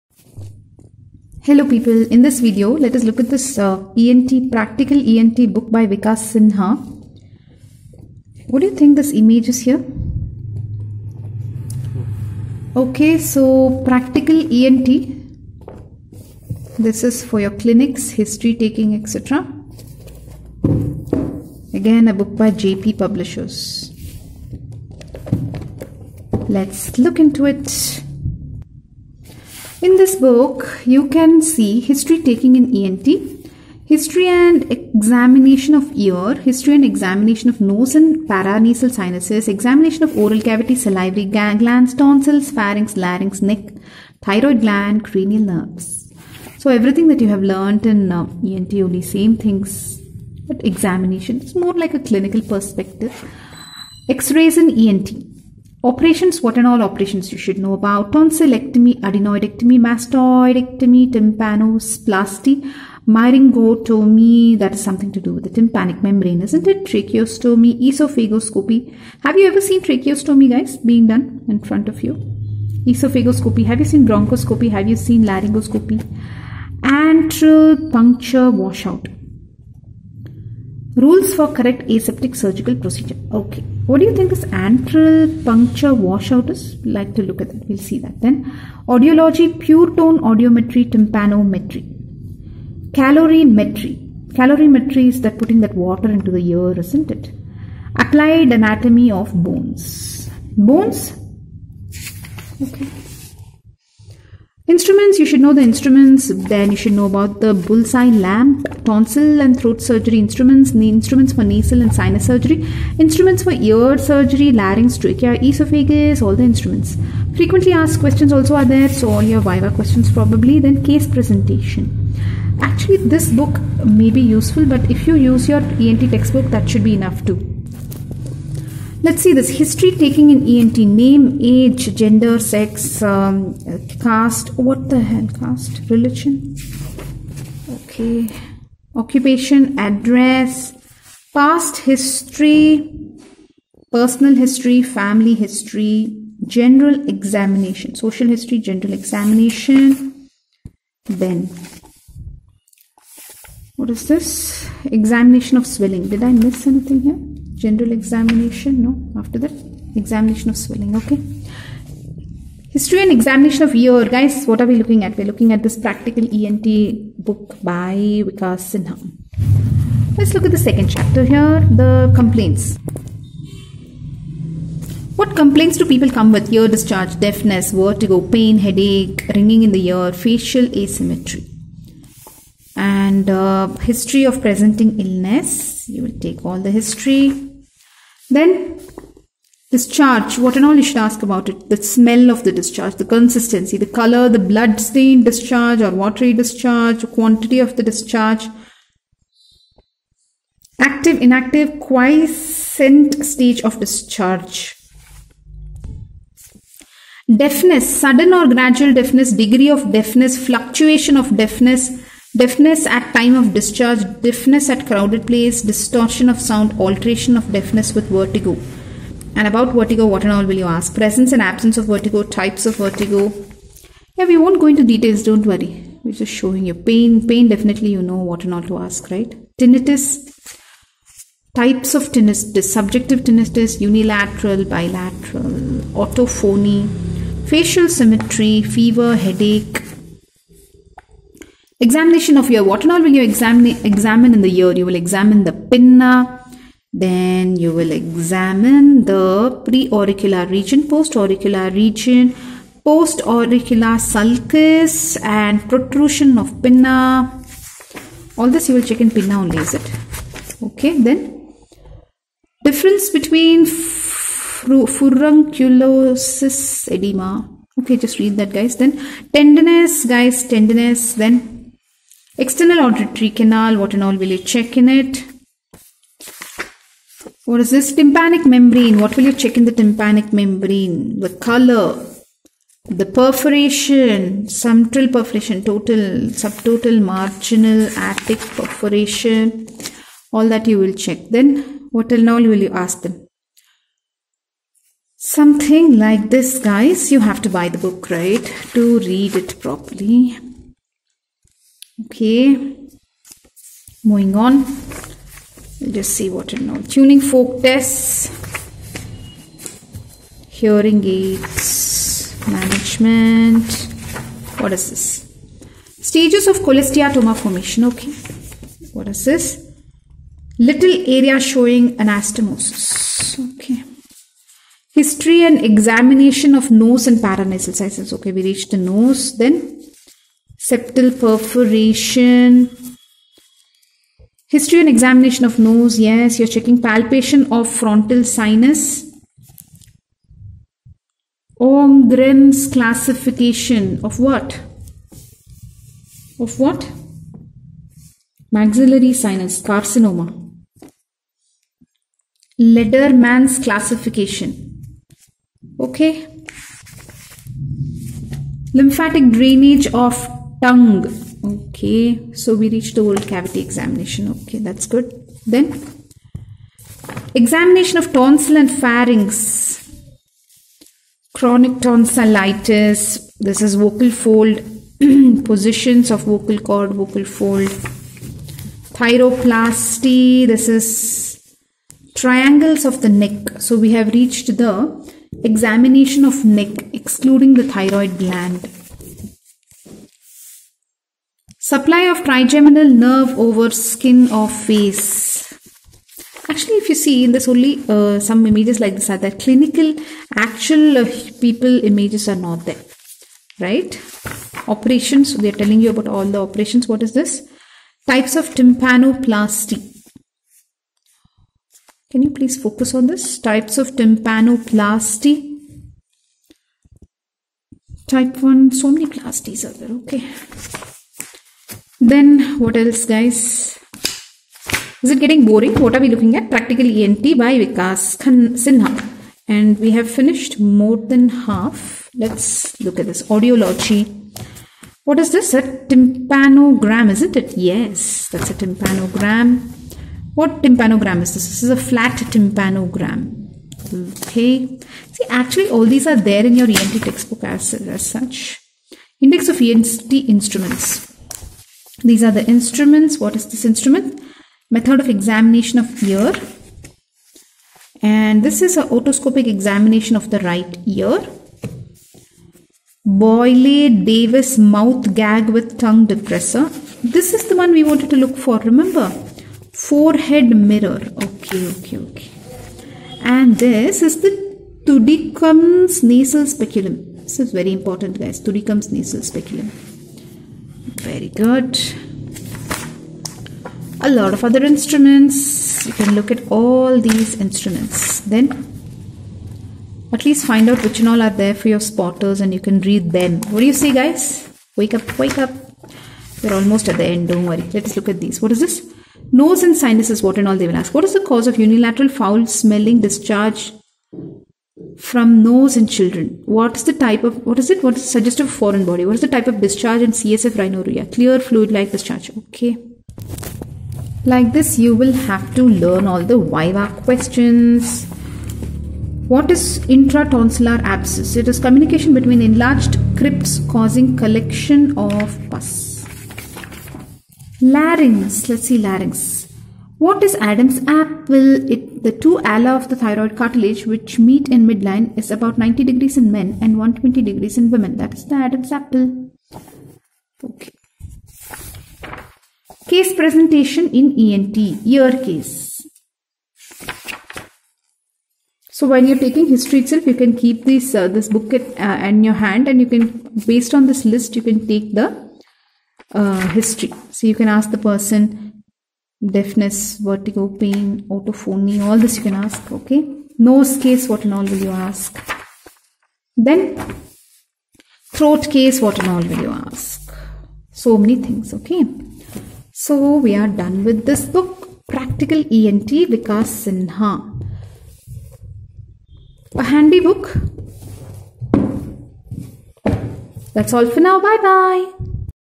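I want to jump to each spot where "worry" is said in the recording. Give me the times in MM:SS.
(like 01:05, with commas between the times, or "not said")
03:45, 08:17.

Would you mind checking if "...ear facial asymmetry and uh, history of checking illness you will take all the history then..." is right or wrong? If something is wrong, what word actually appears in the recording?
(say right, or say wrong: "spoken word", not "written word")
wrong: "presenting", not "checking".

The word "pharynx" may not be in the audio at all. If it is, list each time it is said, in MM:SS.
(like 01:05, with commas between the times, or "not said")
00:42, 06:08.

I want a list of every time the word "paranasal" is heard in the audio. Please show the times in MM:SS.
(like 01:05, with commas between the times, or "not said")
00:38, 05:27.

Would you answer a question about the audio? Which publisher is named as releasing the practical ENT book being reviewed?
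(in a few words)
JP Publishers.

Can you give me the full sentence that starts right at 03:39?
And about vertigo, what and all will you ask?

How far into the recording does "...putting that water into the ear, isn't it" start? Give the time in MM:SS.
01:35.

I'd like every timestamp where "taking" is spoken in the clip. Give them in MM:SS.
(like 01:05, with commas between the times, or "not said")
00:18, 00:32, 02:09, 09:09.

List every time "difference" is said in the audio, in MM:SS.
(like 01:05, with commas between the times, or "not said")
04:22.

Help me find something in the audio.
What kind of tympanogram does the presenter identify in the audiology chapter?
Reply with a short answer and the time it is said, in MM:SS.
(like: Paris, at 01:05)
Flat tympanogram, at 07:21.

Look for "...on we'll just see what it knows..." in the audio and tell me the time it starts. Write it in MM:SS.
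05:04.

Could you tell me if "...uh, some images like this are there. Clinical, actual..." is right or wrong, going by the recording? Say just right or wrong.
right.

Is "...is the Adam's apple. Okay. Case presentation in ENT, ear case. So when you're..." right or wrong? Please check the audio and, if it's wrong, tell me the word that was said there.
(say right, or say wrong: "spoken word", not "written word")
right.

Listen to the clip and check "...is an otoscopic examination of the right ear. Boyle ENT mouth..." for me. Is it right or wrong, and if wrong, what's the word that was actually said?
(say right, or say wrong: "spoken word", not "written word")
wrong: "Davis", not "ENT".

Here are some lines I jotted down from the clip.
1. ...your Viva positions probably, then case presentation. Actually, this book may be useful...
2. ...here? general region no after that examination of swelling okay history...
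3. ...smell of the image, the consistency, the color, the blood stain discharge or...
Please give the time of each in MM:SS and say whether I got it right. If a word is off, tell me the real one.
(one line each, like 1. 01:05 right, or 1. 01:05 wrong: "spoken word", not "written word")
1. 01:59 wrong: "questions", not "positions"
2. 02:37 wrong: "examination", not "region"
3. 03:11 wrong: "discharge", not "image".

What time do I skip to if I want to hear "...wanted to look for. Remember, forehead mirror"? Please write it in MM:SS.
07:47.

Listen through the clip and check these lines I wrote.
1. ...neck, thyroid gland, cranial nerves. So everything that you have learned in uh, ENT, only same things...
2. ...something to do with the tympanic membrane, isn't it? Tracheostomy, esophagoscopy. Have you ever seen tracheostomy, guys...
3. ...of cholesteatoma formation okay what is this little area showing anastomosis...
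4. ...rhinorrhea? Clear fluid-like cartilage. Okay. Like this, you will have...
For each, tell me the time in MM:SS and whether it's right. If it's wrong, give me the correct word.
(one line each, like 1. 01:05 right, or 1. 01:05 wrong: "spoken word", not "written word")
1. 00:43 right
2. 01:04 right
3. 05:16 right
4. 08:30 wrong: "discharge", not "cartilage".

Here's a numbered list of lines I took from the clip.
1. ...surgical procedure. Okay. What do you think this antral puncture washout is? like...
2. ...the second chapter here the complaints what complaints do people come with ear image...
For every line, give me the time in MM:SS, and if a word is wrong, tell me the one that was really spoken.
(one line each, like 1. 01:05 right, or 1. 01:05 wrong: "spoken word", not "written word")
1. 01:22 right
2. 02:50 wrong: "discharge", not "image".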